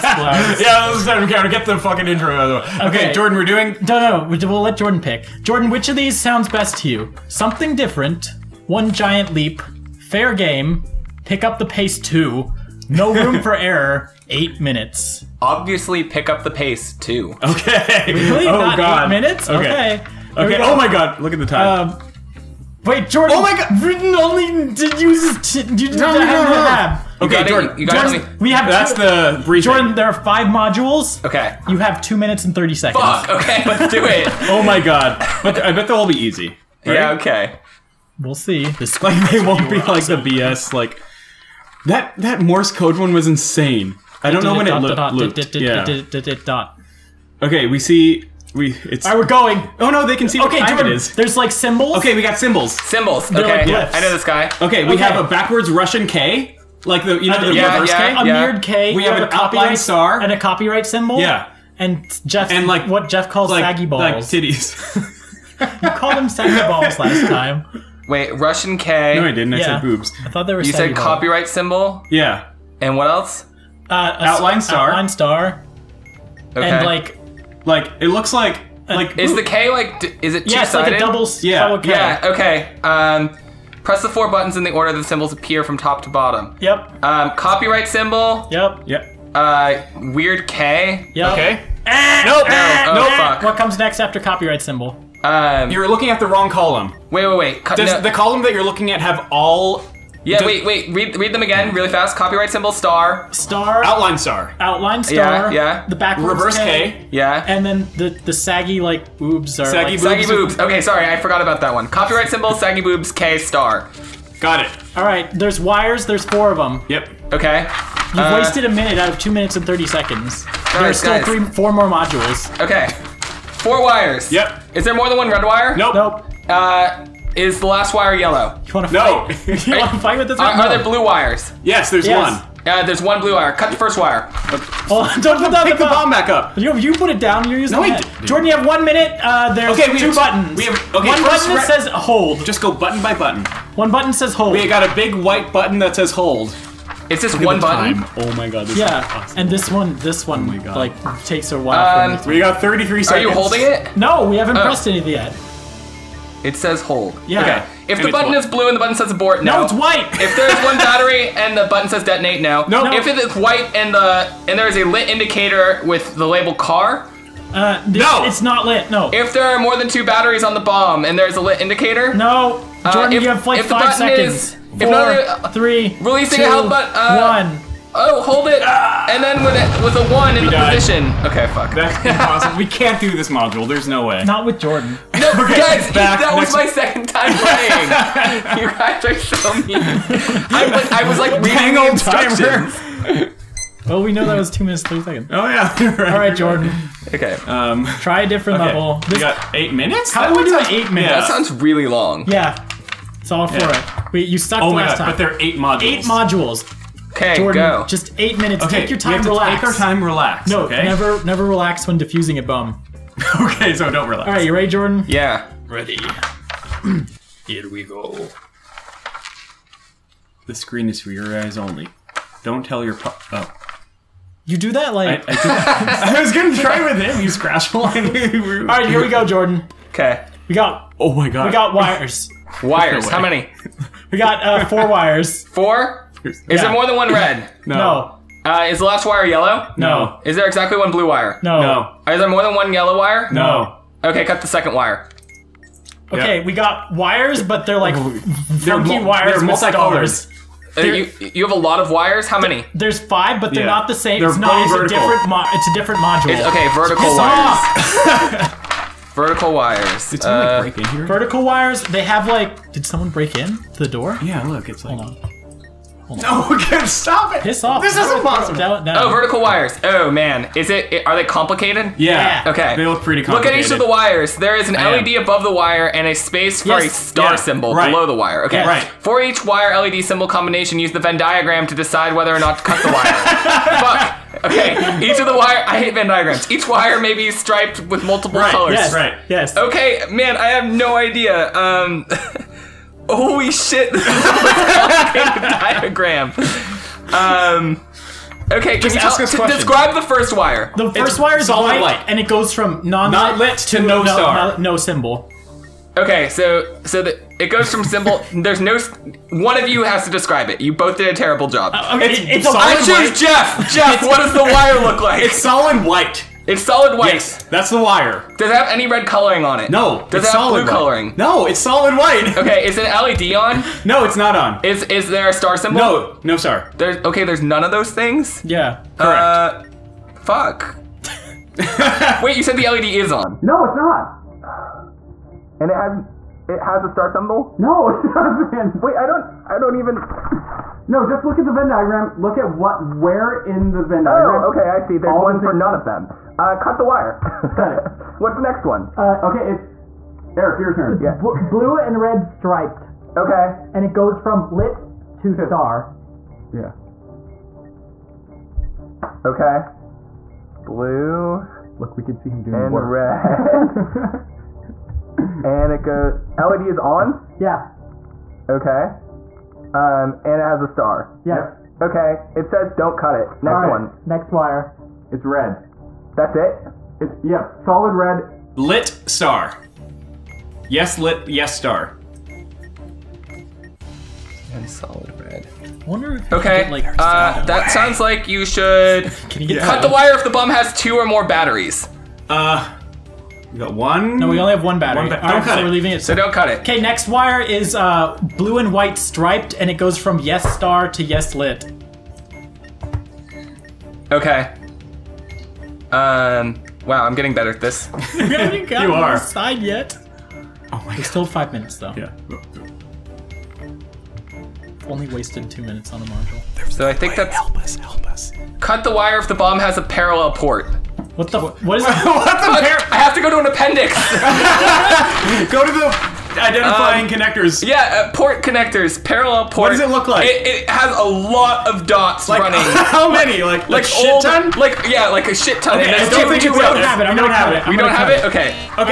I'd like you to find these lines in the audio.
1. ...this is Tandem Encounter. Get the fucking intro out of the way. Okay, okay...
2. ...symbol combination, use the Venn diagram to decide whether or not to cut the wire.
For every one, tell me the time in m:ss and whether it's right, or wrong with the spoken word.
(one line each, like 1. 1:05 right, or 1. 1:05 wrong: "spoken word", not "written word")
1. 0:00 right
2. 4:40 right.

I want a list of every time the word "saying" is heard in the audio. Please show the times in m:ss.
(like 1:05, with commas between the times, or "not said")
not said.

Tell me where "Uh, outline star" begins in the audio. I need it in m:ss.
1:13.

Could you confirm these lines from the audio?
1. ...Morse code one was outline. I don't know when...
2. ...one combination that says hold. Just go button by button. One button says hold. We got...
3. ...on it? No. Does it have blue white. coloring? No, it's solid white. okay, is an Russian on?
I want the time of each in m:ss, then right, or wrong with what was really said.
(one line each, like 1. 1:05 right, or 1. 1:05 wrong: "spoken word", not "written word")
1. 0:42 wrong: "insane", not "outline"
2. 2:21 wrong: "button", not "combination"
3. 5:19 wrong: "LED", not "Russian".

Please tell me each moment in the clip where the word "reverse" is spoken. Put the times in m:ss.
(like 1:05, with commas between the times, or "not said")
0:57, 1:46.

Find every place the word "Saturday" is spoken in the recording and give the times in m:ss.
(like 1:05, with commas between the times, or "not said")
not said.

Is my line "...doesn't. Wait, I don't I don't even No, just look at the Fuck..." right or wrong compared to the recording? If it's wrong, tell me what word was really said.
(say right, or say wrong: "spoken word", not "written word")
wrong: "Venn", not "Fuck".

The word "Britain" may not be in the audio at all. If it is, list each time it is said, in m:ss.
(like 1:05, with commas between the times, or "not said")
0:23.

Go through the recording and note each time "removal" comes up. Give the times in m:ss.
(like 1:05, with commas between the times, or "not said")
not said.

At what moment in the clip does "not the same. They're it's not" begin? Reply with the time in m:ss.
4:13.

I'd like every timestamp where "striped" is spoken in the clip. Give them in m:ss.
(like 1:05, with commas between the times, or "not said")
4:47, 5:52, 6:38.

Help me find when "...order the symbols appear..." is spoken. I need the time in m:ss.
1:24.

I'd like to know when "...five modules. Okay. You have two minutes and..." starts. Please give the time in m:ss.
0:30.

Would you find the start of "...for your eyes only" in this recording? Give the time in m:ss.
3:40.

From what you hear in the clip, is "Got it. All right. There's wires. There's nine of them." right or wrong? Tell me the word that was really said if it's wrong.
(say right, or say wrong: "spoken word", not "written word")
wrong: "four", not "nine".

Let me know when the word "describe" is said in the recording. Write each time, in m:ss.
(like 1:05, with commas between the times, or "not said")
4:59, 5:10.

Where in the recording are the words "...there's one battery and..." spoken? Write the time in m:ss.
2:40.